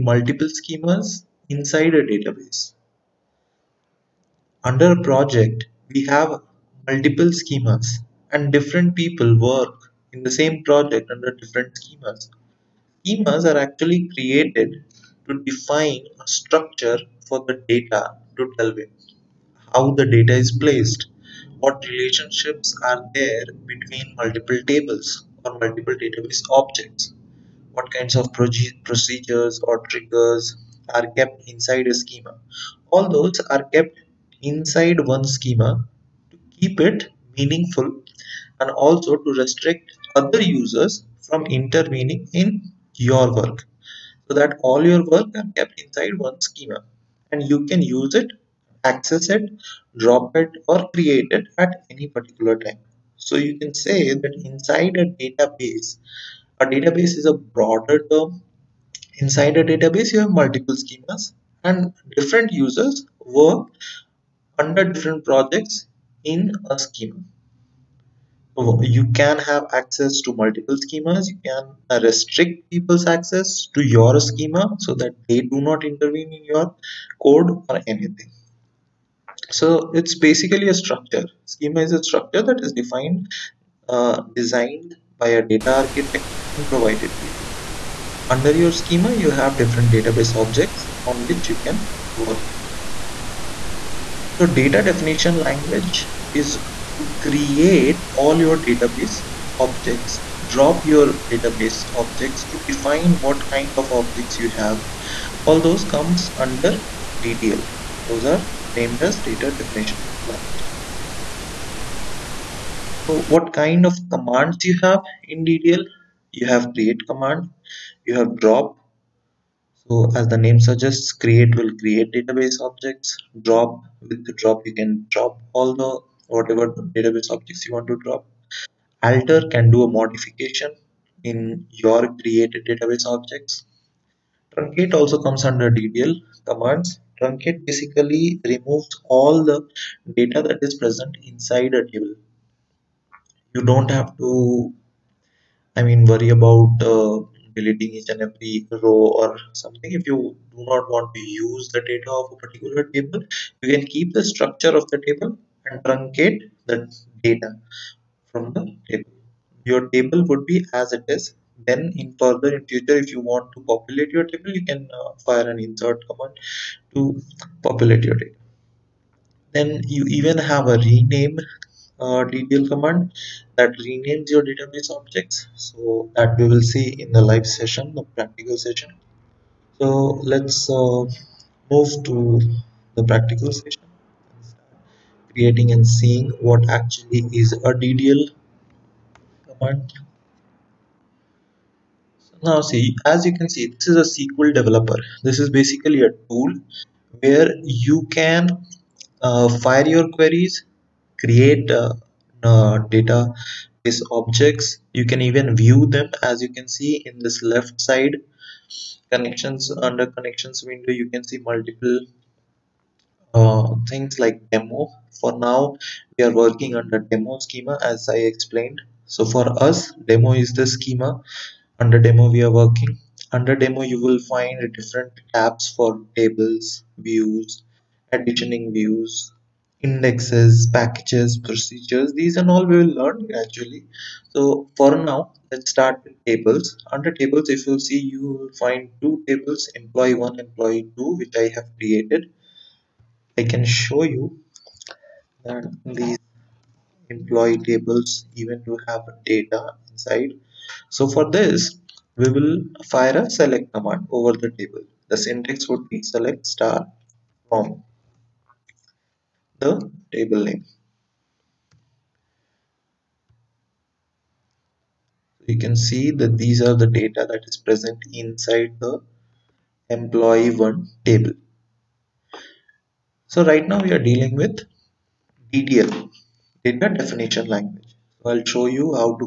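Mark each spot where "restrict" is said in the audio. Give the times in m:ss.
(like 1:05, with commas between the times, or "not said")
0:39, 1:12.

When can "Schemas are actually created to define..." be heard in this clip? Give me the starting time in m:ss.
0:13.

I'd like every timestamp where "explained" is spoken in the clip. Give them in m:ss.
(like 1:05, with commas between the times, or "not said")
3:38.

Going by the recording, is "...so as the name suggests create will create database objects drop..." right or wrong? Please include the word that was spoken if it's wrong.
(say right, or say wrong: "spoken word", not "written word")
right.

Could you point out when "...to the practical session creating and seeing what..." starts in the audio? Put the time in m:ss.
3:02.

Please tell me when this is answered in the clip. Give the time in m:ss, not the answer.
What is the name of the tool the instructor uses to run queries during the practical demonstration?
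3:14.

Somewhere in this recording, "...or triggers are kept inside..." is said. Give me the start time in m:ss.
0:29.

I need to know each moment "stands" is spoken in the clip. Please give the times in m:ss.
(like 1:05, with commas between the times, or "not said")
not said.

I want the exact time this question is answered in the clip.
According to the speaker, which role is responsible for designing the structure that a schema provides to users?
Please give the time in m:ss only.
1:25.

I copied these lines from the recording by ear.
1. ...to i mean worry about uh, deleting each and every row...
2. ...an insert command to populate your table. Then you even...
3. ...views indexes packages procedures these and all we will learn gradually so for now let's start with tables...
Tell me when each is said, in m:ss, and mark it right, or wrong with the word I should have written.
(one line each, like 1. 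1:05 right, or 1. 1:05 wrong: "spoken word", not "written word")
1. 2:24 right
2. 2:45 right
3. 3:48 right.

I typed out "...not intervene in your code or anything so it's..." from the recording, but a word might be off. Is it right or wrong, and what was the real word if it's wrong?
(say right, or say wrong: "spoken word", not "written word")
right.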